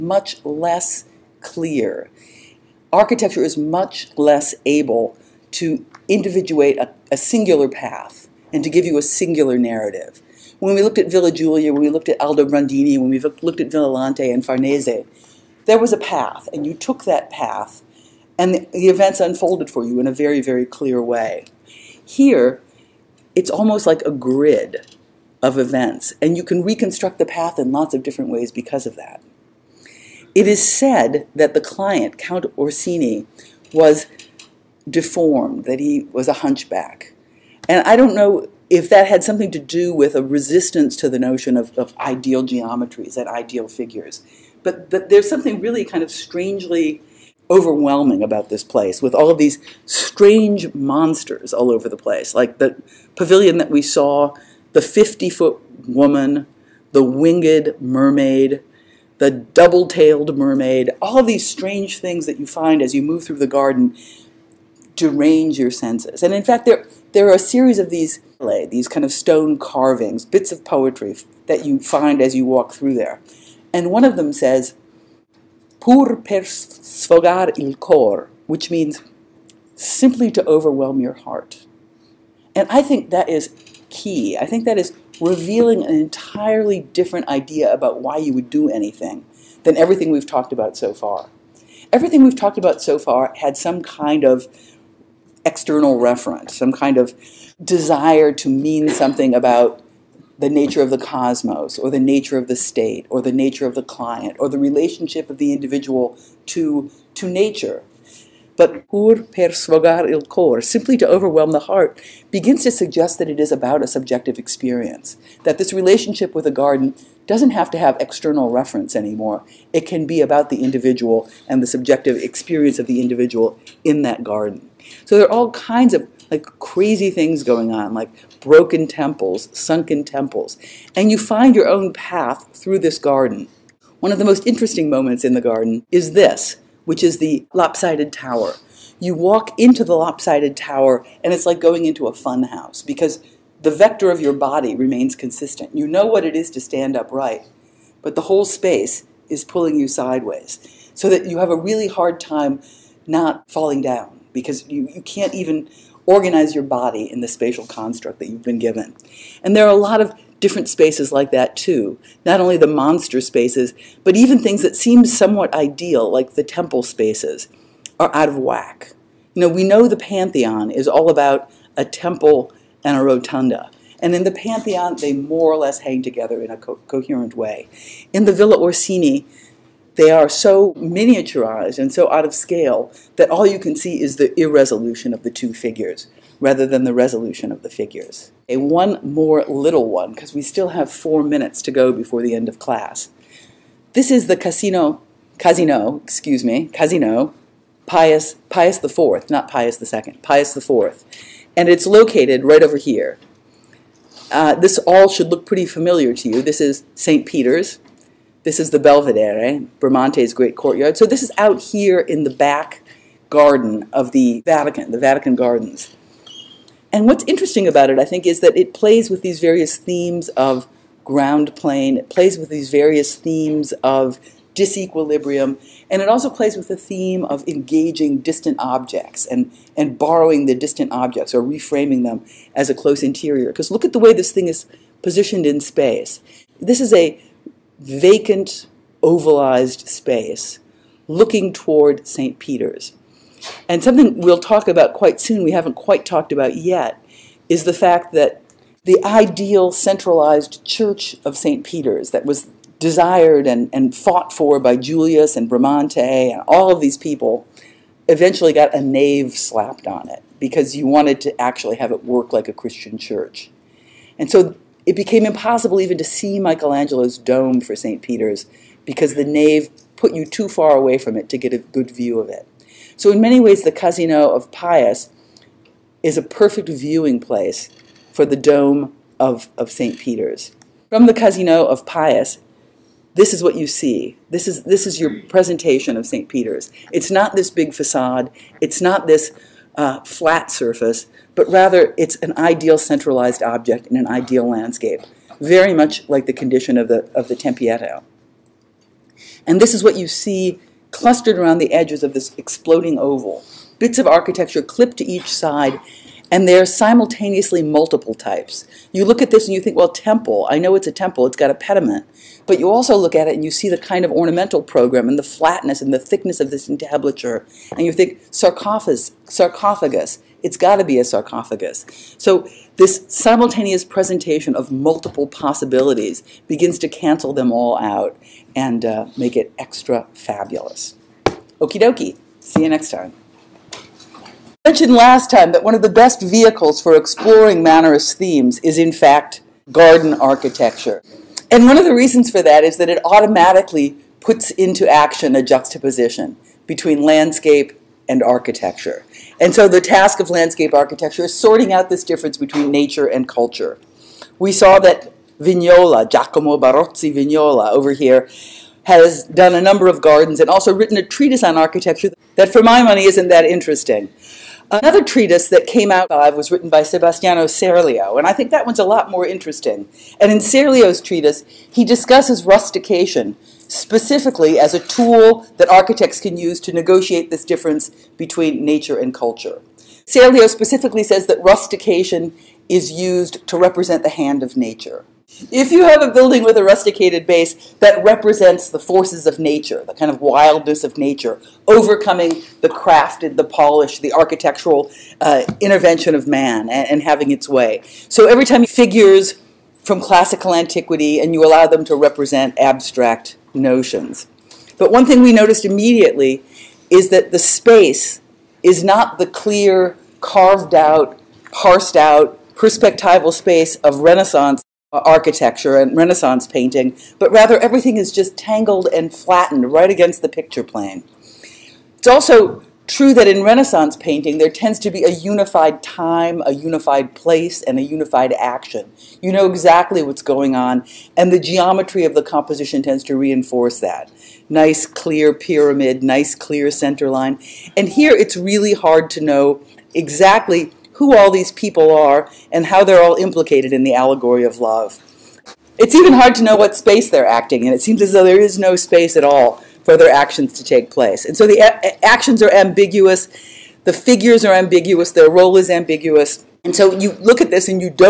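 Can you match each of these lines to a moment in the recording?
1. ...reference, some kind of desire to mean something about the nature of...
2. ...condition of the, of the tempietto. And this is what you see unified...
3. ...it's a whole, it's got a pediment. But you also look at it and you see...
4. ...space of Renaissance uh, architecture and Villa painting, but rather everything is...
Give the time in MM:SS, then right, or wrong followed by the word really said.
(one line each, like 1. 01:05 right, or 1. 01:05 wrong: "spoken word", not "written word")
1. 01:35 right
2. 04:56 wrong: "clustered", not "unified"
3. 05:10 wrong: "temple", not "whole"
4. 06:53 wrong: "Renaissance", not "Villa".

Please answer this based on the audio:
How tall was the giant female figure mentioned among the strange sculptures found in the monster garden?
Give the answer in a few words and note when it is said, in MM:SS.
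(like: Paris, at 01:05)
50 foot, at 00:54.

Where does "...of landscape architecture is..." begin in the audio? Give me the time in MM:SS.
05:50.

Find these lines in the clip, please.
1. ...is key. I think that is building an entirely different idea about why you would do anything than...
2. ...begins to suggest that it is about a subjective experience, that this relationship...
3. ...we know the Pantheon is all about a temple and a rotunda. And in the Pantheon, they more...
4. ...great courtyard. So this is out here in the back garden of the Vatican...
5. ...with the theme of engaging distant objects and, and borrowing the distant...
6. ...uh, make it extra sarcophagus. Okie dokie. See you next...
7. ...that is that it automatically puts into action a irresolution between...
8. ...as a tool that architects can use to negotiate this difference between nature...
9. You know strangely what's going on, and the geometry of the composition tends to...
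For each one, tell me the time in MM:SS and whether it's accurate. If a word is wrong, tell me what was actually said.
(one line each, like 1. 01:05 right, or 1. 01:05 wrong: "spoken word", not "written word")
1. 01:23 wrong: "revealing", not "building"
2. 01:52 right
3. 02:49 right
4. 03:30 right
5. 03:46 right
6. 05:28 wrong: "fabulous", not "sarcophagus"
7. 05:42 wrong: "juxtaposition", not "irresolution"
8. 06:14 right
9. 07:09 wrong: "exactly", not "strangely".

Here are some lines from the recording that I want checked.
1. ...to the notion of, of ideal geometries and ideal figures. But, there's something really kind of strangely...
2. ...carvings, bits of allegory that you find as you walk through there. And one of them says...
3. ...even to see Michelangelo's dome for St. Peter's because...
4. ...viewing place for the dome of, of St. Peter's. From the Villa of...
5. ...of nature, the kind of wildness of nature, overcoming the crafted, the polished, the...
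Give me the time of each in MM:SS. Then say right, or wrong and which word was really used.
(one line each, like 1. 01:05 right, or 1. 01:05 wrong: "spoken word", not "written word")
1. 00:40 right
2. 01:09 wrong: "poetry", not "allegory"
3. 04:25 right
4. 04:36 wrong: "Casino", not "Villa"
5. 06:29 right.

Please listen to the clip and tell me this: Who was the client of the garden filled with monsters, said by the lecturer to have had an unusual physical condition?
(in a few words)
Count Orsini.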